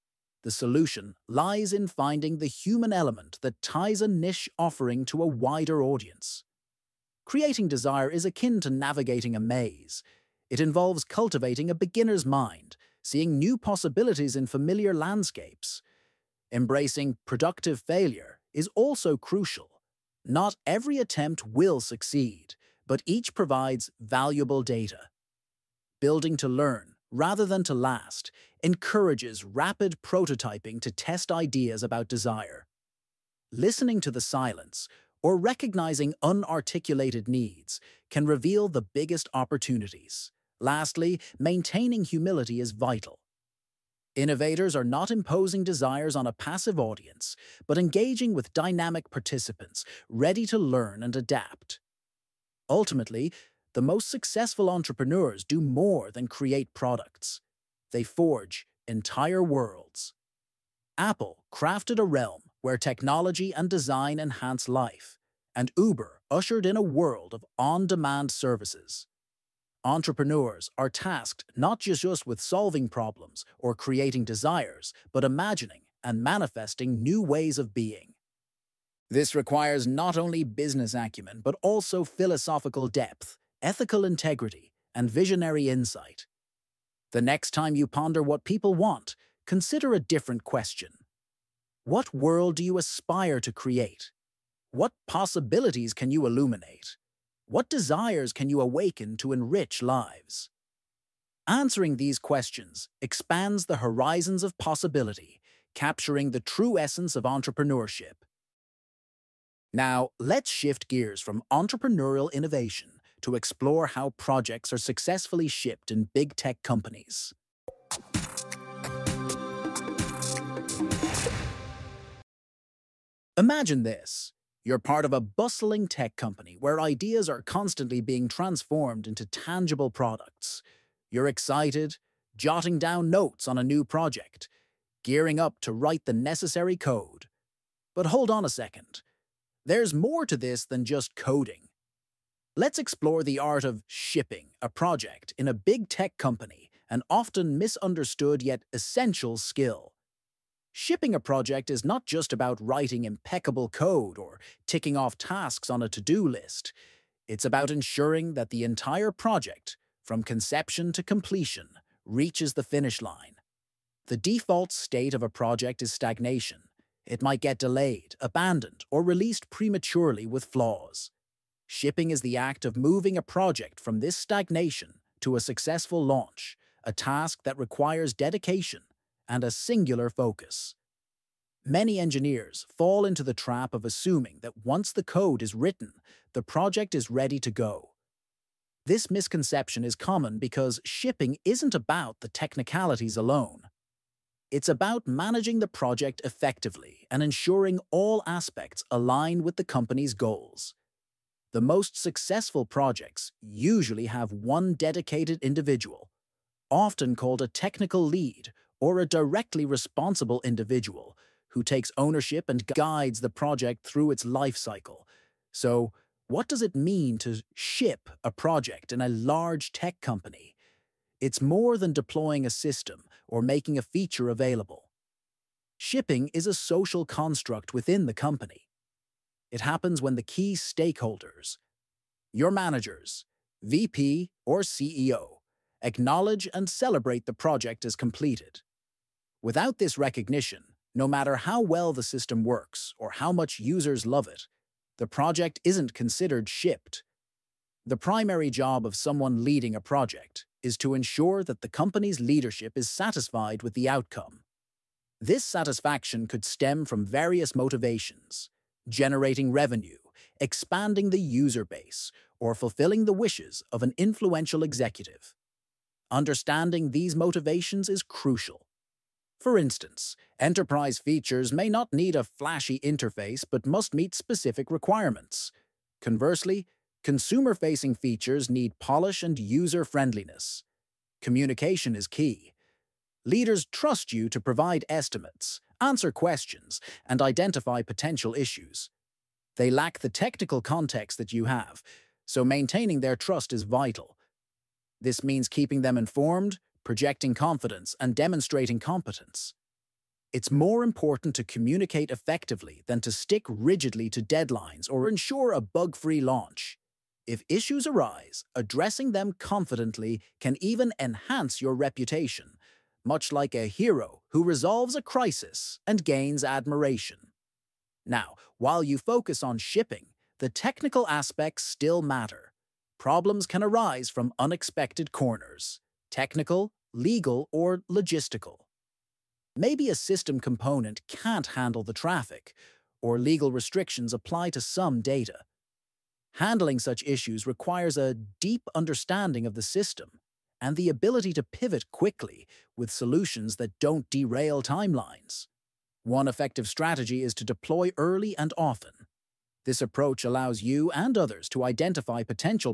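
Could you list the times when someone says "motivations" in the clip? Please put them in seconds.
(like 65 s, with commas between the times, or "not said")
257 s, 267 s.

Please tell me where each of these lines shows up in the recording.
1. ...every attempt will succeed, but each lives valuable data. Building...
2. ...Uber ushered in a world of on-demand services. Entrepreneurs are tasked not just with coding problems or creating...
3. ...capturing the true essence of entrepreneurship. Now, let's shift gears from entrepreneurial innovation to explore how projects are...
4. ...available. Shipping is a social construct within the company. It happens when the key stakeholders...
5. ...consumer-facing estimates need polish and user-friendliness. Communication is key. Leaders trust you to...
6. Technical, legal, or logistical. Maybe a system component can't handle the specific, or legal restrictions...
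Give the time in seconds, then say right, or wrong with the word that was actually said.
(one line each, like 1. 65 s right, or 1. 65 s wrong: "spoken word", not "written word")
1. 20 s wrong: "provides", not "lives"
2. 65 s wrong: "solving", not "coding"
3. 105 s right
4. 224 s right
5. 277 s wrong: "features", not "estimates"
6. 326 s wrong: "traffic", not "specific".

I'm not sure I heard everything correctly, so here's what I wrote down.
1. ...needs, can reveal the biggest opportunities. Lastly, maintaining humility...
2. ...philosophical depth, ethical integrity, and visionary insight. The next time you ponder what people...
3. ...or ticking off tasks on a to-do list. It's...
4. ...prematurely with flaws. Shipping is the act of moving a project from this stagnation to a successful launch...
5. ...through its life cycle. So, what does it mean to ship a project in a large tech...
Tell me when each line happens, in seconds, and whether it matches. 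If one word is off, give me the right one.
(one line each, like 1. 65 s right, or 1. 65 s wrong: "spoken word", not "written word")
1. 37 s right
2. 82 s right
3. 154 s right
4. 169 s right
5. 213 s right.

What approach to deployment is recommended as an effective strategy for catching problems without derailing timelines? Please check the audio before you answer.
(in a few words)
Deploy early and often.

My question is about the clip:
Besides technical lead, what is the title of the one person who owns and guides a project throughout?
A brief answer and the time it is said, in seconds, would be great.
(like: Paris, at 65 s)
Directly responsible individual, at 209 s.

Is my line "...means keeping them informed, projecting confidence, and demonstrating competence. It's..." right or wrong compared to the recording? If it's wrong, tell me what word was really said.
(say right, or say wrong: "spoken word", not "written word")
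right.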